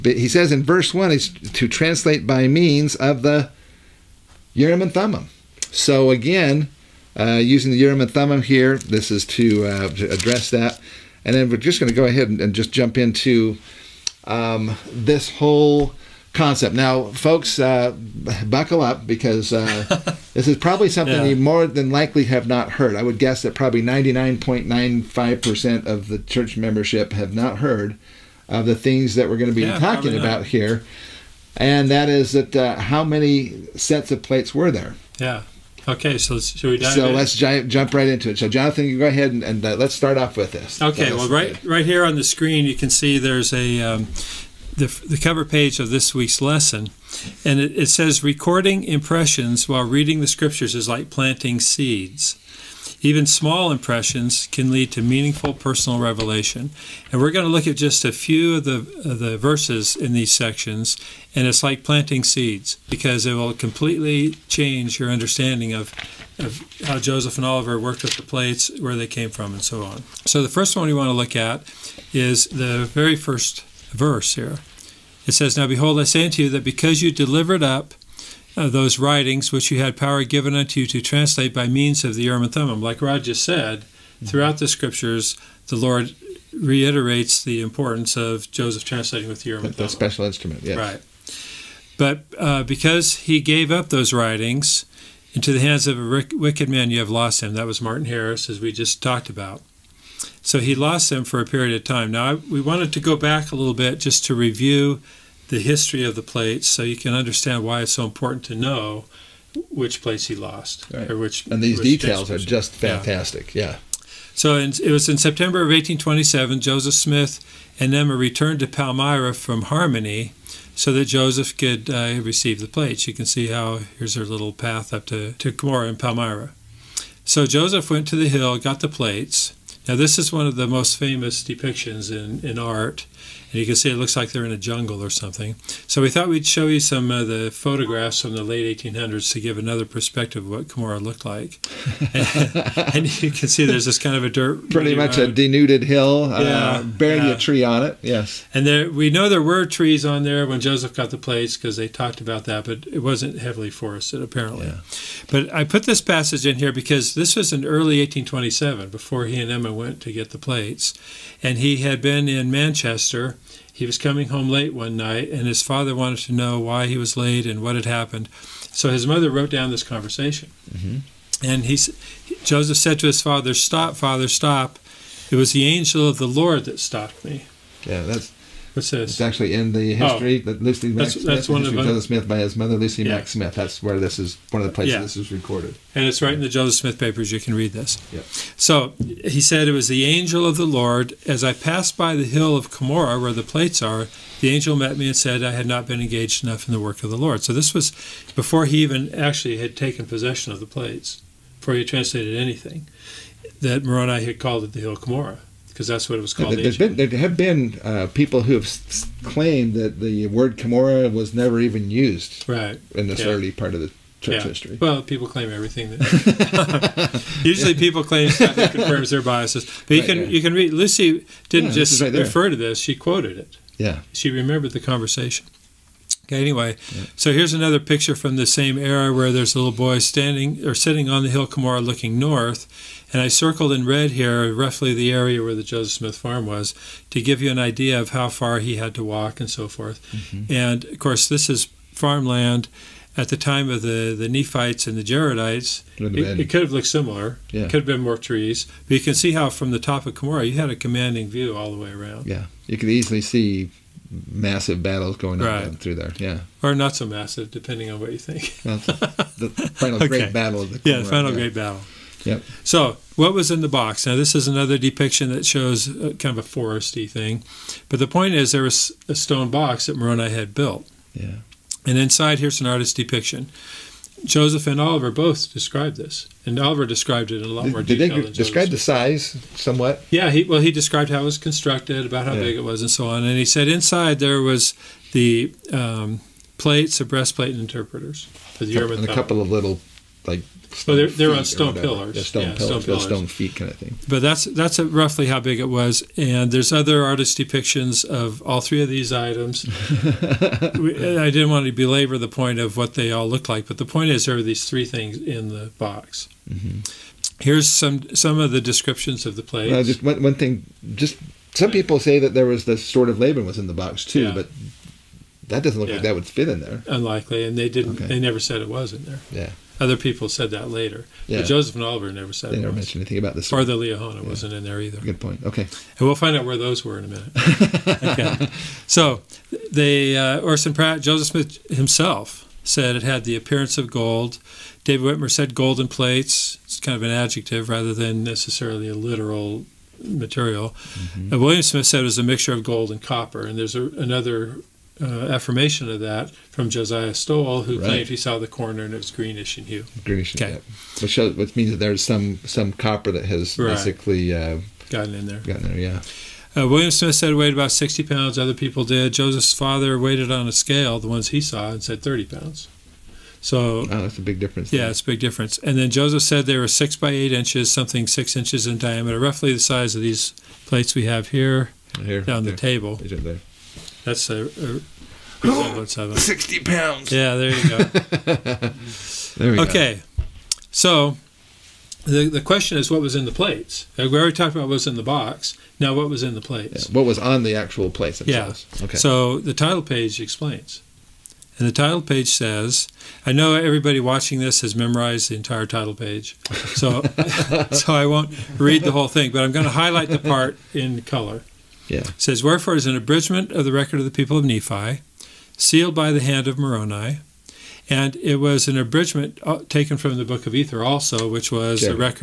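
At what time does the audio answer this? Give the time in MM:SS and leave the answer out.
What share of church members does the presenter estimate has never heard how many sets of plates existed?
00:23.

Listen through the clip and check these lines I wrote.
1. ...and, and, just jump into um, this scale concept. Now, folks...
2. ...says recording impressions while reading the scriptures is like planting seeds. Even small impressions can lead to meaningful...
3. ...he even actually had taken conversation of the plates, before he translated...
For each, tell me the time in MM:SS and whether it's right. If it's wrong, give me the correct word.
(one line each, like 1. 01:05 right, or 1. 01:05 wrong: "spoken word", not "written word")
1. 00:12 wrong: "whole", not "scale"
2. 00:47 right
3. 03:18 wrong: "possession", not "conversation".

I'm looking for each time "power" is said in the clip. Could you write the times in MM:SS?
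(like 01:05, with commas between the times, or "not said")
01:19.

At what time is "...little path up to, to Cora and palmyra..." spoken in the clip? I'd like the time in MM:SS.
02:04.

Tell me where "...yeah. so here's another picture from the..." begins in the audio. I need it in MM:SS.
03:46.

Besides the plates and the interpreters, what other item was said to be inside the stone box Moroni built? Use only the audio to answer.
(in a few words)
a breastplate.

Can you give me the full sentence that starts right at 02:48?
So his mother wrote down this conversation.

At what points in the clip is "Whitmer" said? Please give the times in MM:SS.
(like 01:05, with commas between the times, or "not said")
05:35.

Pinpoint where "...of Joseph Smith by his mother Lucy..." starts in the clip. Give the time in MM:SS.
03:01.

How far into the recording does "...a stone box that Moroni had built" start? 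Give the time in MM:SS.
04:29.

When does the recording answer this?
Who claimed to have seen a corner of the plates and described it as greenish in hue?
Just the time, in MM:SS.
05:46.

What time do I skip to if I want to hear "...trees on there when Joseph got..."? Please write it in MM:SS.
02:29.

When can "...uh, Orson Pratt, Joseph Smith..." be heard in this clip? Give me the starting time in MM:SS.
05:30.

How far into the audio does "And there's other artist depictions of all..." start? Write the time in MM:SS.
04:56.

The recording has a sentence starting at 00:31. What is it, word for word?
And that is that uh, how many sets of plates were there?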